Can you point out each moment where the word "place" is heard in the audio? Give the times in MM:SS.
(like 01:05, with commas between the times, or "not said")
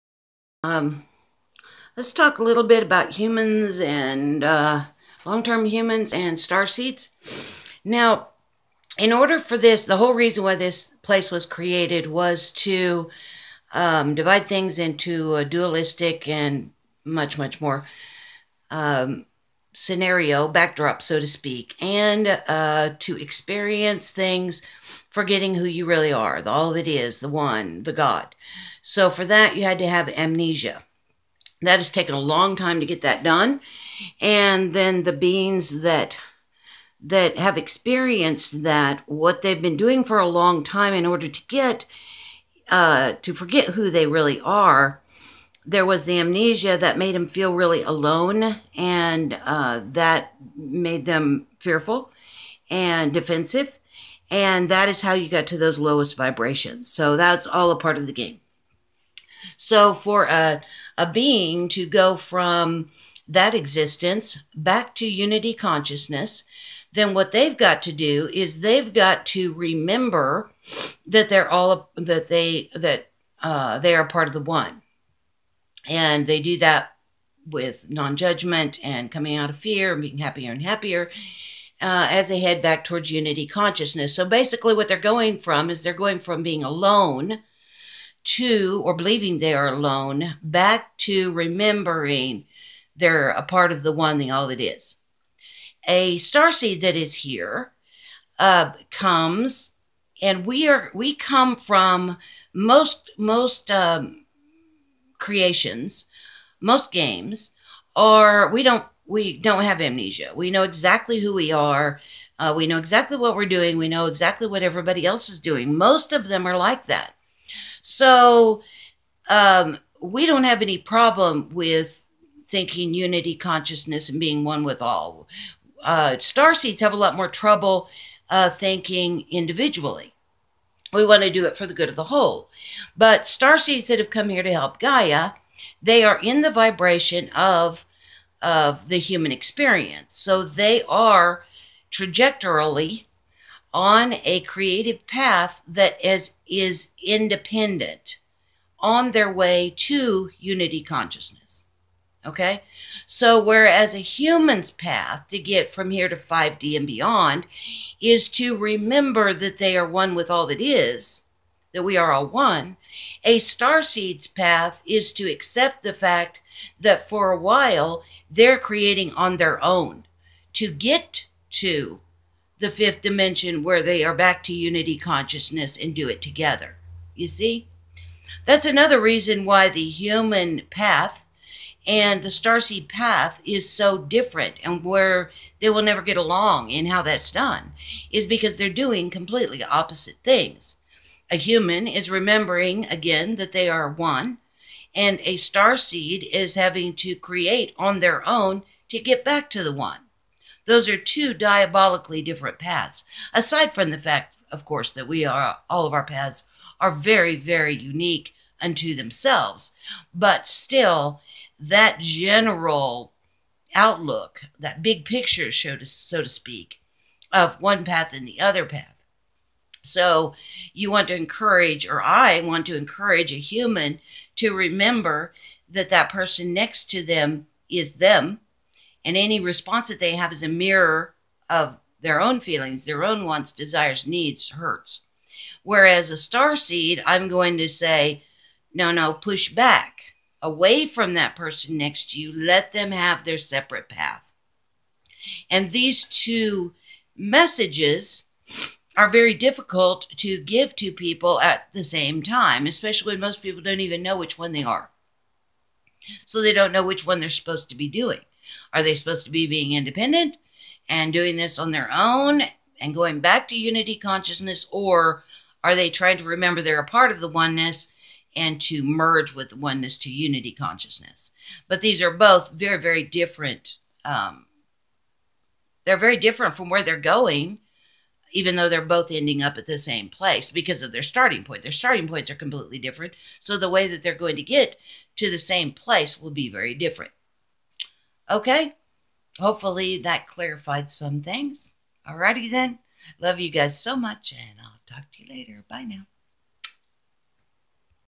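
00:11, 04:40, 04:45.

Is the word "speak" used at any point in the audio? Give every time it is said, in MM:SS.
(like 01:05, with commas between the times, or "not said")
00:21, 03:36.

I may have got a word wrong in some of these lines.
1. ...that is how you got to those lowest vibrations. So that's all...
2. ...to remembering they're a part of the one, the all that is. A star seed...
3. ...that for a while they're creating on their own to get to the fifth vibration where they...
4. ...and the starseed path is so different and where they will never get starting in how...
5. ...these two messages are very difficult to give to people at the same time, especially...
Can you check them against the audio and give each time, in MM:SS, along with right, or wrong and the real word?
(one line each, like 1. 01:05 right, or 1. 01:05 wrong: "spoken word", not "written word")
1. 00:54 right
2. 01:30 right
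3. 02:46 wrong: "dimension", not "vibration"
4. 03:01 wrong: "along", not "starting"
5. 04:05 right.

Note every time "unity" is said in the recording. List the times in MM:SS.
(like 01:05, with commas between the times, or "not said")
01:05, 01:23, 02:02, 02:30, 02:54, 04:23, 04:30.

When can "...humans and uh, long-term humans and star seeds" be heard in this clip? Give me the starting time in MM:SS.
00:03.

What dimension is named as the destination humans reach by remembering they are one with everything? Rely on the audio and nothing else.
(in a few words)
5D.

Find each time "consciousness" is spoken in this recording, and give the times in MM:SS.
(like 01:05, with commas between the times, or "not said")
01:05, 01:23, 02:03, 02:30, 02:54, 04:23, 04:30.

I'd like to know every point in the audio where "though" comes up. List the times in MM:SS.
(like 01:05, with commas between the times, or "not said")
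04:38.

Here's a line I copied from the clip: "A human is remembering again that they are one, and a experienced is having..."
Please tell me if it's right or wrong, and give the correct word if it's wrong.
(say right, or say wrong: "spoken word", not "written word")
wrong: "starseed", not "experienced".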